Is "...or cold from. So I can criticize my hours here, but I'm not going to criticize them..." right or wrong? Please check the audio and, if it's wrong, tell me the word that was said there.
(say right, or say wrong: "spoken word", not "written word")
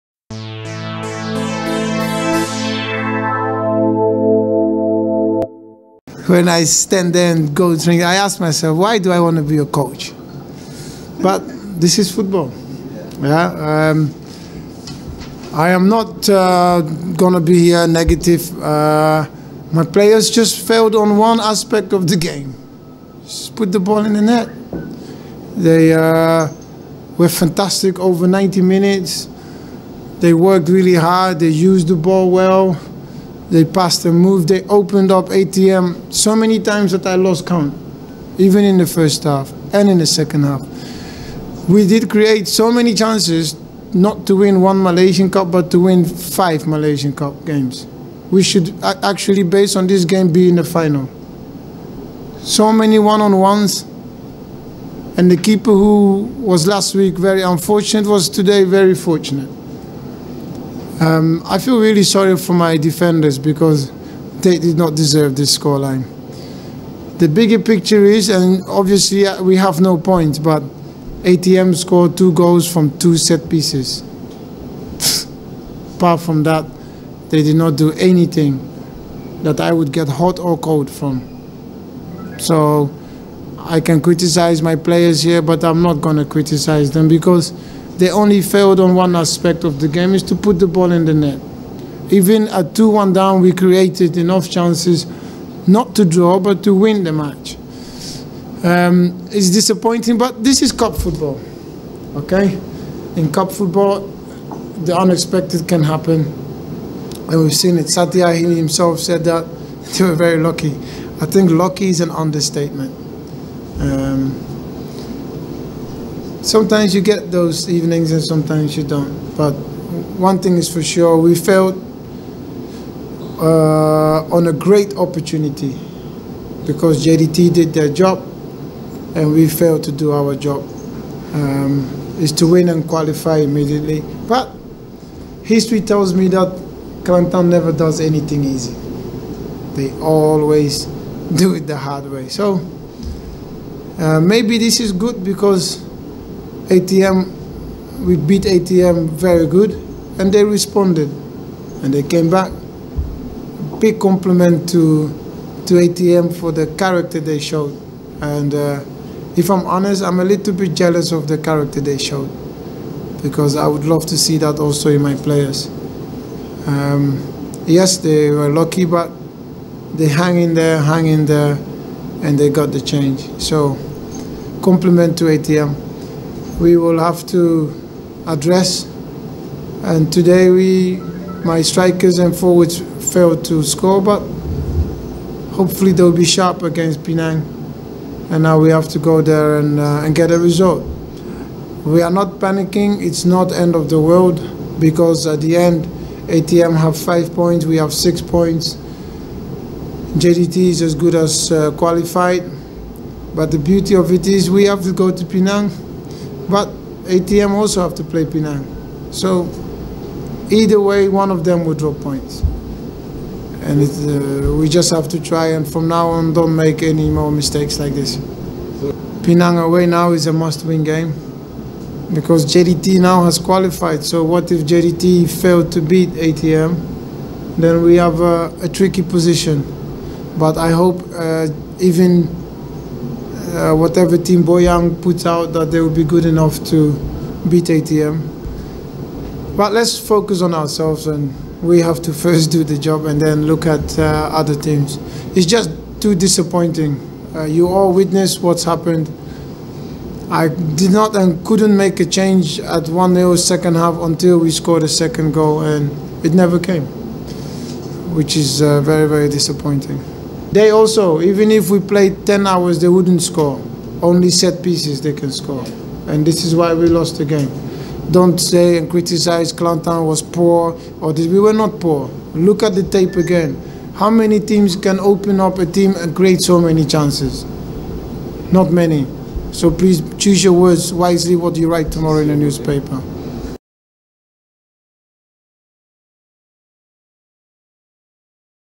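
wrong: "players", not "hours".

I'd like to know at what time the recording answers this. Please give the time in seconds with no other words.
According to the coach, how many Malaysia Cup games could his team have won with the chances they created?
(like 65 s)
46 s.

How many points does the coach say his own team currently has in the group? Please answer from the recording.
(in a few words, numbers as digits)
6.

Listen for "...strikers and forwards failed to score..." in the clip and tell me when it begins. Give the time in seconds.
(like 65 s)
181 s.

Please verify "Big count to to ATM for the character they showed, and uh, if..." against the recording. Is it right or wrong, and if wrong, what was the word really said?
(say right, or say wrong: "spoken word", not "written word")
wrong: "compliment", not "count".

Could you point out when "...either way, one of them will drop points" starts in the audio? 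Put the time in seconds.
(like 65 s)
210 s.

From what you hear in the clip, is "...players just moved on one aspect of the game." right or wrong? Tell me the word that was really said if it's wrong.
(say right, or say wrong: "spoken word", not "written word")
wrong: "failed", not "moved".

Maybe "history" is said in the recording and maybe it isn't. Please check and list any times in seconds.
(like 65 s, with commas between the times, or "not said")
135 s.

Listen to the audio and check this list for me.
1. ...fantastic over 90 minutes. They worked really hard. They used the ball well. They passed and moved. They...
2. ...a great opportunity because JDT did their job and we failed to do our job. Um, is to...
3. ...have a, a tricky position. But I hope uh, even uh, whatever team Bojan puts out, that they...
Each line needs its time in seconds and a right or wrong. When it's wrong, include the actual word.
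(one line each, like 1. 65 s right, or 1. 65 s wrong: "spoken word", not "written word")
1. 27 s right
2. 124 s right
3. 227 s right.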